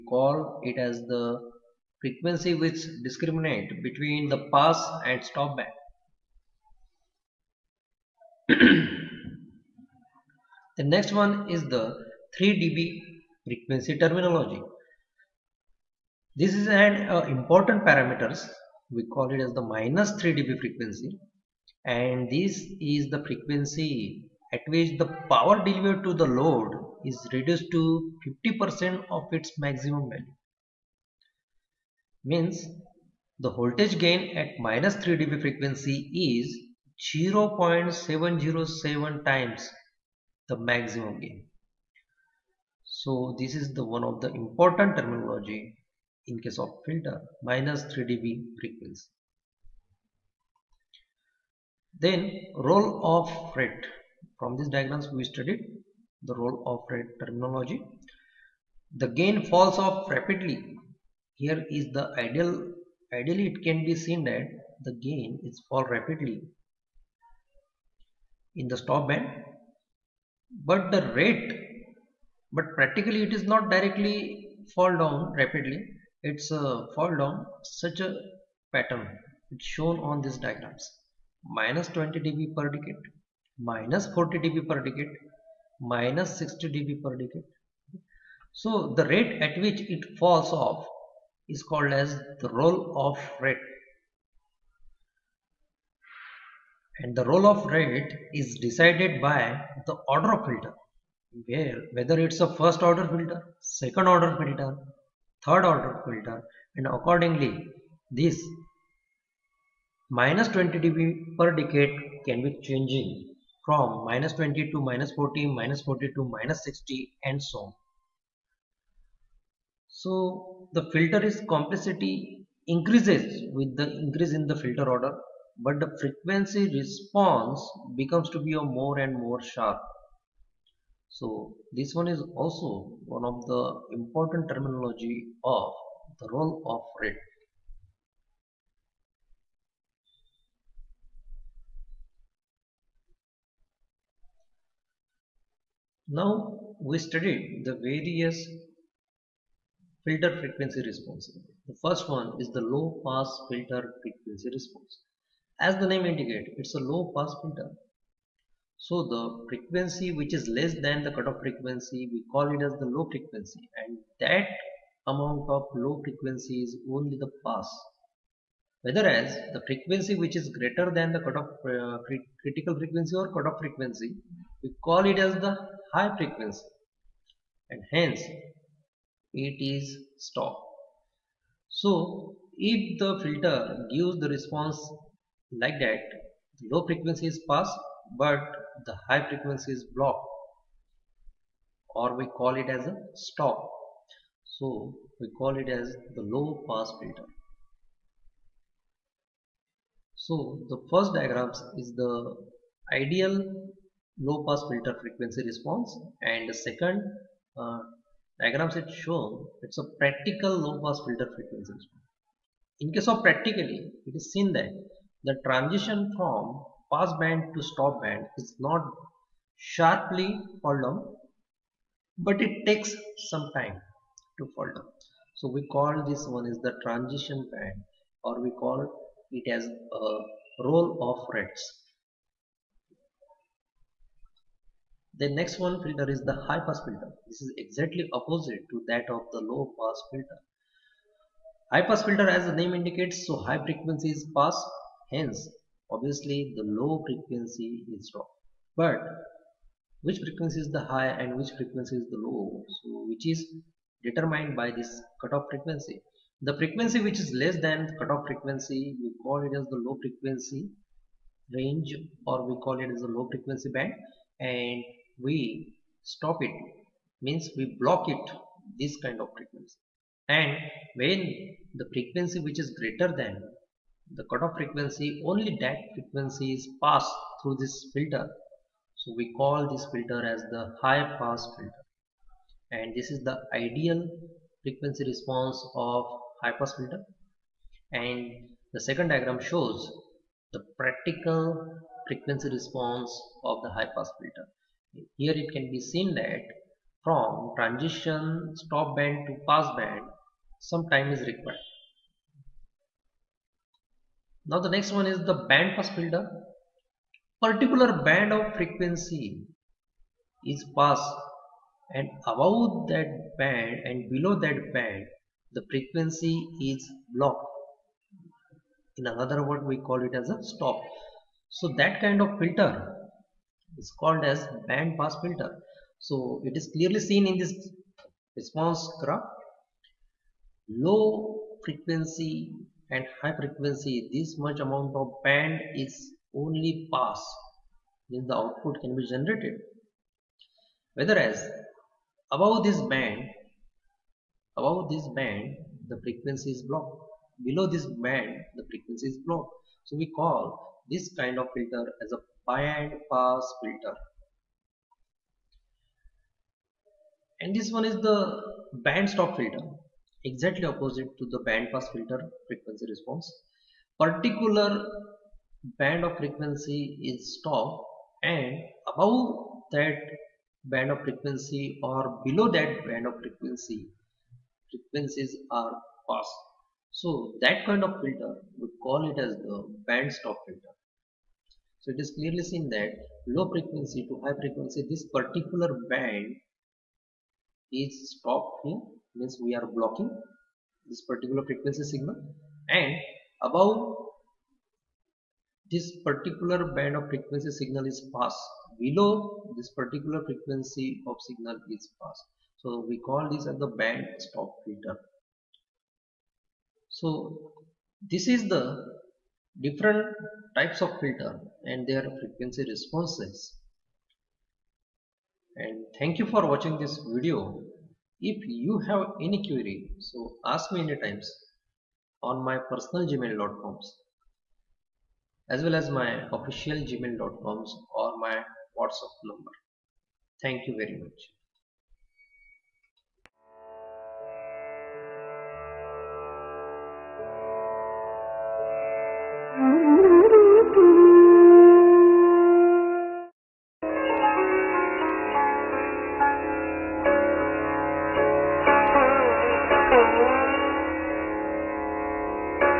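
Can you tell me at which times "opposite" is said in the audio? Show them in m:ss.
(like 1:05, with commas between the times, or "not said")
3:58, 6:00.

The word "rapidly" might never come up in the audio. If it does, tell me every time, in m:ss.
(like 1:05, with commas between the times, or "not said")
1:00, 1:05, 1:15.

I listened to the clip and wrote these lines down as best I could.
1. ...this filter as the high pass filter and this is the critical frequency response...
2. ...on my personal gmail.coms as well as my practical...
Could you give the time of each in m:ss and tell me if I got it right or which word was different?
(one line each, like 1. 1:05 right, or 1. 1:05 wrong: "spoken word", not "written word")
1. 4:39 wrong: "ideal", not "critical"
2. 7:02 wrong: "official", not "practical".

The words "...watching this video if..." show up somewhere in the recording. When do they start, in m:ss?
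6:56.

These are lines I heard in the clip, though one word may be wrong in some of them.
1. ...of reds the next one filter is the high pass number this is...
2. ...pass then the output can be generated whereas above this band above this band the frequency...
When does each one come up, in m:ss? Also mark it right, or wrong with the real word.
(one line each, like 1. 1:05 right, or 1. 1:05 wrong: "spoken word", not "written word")
1. 3:51 wrong: "filter", not "number"
2. 5:36 right.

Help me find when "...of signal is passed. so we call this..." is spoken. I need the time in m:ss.
6:41.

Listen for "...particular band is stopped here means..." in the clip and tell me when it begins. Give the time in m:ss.
6:25.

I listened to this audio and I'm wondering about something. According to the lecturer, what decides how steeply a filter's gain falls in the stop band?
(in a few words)
the order of filter.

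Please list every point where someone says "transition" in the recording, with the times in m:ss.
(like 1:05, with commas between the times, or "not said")
3:35, 3:46, 4:57.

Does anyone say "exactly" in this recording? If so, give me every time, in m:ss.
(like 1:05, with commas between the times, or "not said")
3:57, 6:00.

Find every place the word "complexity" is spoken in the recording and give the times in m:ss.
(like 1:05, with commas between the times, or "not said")
2:01.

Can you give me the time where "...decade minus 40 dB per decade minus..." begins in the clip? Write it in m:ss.
1:22.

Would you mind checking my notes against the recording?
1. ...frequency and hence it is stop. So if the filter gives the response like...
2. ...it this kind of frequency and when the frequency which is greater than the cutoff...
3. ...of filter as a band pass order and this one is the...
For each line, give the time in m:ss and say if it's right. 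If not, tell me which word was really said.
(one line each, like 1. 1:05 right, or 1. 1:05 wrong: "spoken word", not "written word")
1. 2:56 right
2. 4:28 right
3. 5:51 wrong: "filter", not "order".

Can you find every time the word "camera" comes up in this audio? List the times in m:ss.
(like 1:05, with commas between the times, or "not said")
not said.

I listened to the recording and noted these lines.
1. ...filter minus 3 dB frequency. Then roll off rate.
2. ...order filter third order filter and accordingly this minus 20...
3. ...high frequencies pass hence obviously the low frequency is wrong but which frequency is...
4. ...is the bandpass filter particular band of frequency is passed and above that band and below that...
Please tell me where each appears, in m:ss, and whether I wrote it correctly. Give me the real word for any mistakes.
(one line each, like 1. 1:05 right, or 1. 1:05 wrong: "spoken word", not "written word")
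1. 0:46 right
2. 1:44 right
3. 4:03 right
4. 5:05 right.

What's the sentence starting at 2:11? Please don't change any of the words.
So this one is also one of the important terminology of the roll off rate.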